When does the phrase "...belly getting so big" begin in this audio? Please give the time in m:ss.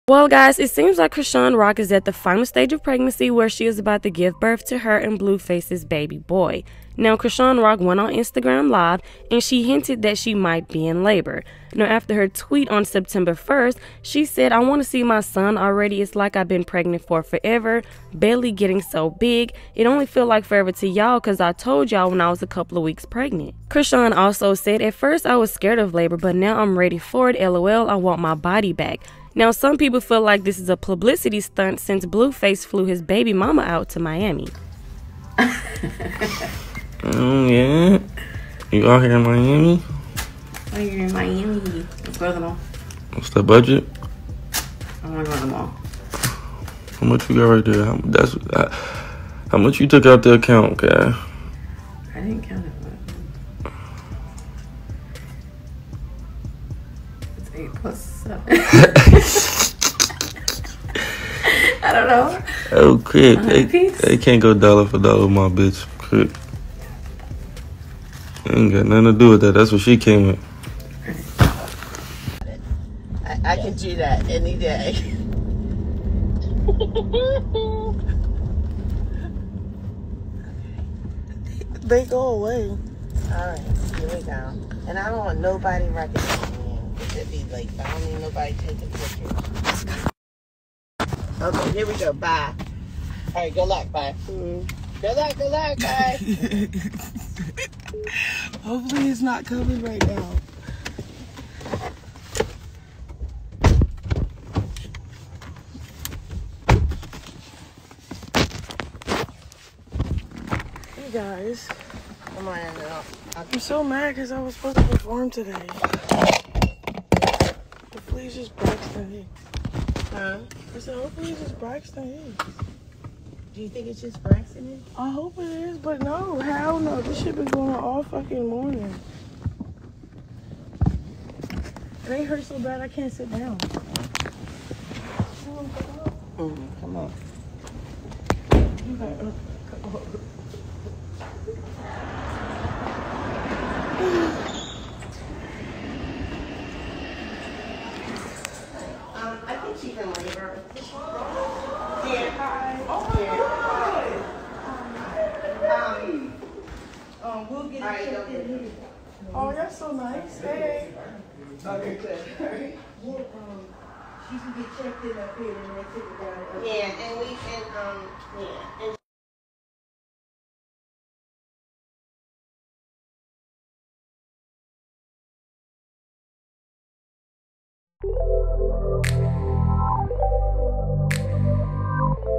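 0:18.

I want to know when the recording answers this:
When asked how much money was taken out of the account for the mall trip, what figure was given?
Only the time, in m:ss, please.
0:57.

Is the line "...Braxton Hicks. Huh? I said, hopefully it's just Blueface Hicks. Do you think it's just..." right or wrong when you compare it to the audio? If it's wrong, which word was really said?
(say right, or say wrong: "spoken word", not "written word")
wrong: "Braxton", not "Blueface".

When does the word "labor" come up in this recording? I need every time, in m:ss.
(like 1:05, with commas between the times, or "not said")
0:11, 0:25, 2:30.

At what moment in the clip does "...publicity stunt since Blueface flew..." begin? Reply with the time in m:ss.
0:30.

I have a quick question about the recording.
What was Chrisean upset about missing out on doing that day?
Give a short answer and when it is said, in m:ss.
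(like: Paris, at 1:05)
perform, at 1:54.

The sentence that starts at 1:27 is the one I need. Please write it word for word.
It'd be like, I don't need nobody taking pictures.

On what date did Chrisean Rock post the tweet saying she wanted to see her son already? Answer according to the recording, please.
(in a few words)
September 1.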